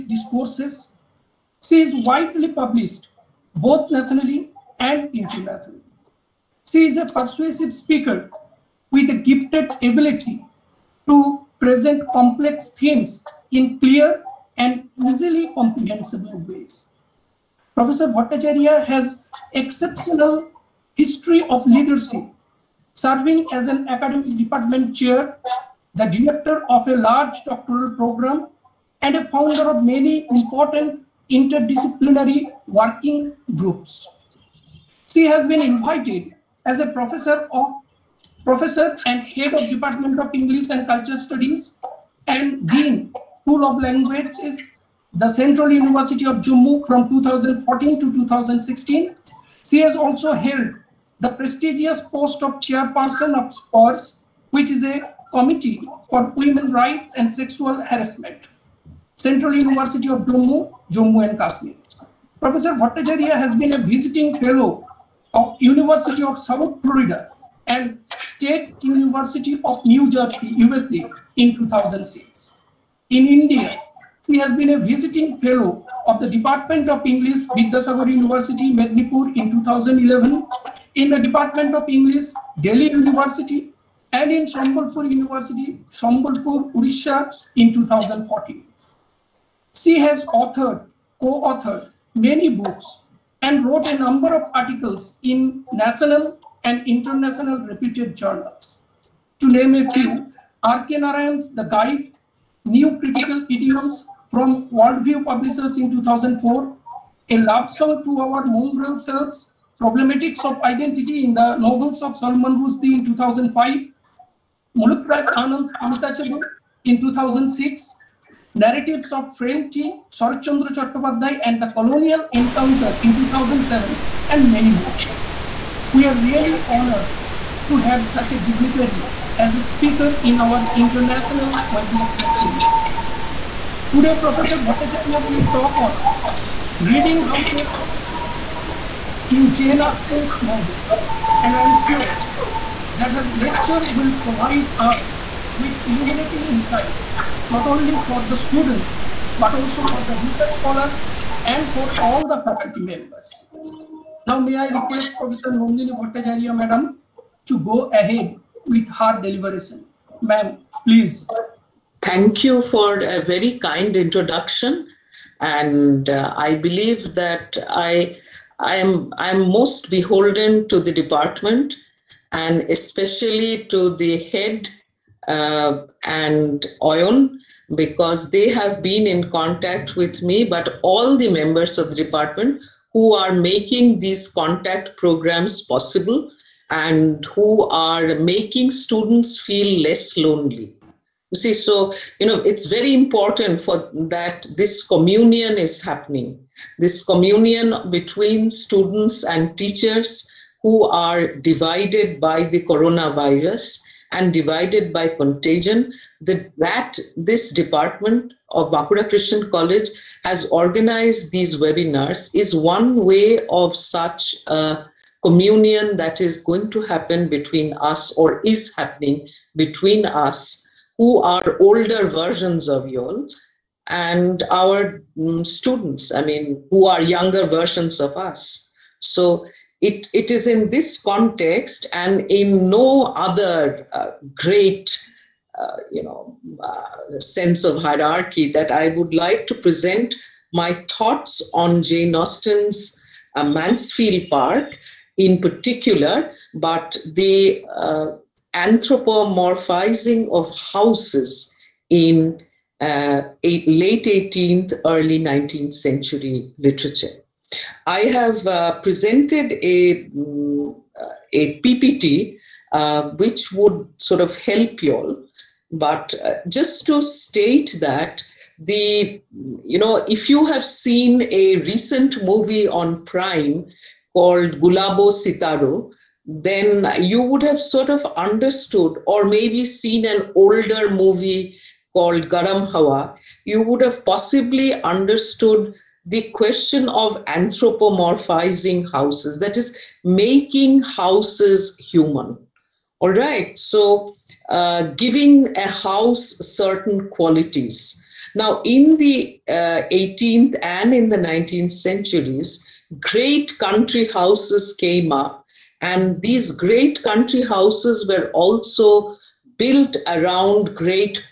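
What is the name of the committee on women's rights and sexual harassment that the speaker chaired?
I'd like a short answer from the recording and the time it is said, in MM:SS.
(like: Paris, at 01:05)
SPORS, at 00:53.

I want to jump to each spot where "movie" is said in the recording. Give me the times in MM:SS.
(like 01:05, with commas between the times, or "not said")
04:32, 04:40.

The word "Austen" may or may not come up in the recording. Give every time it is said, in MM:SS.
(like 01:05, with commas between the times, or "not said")
02:19, 04:02.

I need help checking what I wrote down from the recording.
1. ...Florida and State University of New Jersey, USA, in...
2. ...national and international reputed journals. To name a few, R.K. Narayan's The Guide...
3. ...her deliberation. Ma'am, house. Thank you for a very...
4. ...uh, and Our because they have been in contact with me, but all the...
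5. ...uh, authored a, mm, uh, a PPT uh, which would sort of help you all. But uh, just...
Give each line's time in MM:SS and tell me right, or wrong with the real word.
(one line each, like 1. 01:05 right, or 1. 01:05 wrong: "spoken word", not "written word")
1. 01:06 right
2. 01:35 right
3. 02:38 wrong: "please", not "house"
4. 02:55 wrong: "Oyon", not "Our"
5. 04:18 wrong: "presented", not "authored".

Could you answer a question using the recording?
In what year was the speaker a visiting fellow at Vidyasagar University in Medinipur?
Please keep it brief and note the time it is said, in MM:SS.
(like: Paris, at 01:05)
2011, at 01:19.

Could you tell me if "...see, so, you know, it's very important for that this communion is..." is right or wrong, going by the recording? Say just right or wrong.
right.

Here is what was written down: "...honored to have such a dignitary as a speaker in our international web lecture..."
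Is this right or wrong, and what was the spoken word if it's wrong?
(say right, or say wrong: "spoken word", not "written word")
right.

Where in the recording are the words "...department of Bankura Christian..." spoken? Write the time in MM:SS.
03:27.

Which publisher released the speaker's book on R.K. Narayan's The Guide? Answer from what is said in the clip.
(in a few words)
Worldview Publishers.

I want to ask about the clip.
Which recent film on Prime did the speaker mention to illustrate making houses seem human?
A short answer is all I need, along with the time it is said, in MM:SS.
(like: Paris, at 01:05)
Gulabo Sitabo, at 04:34.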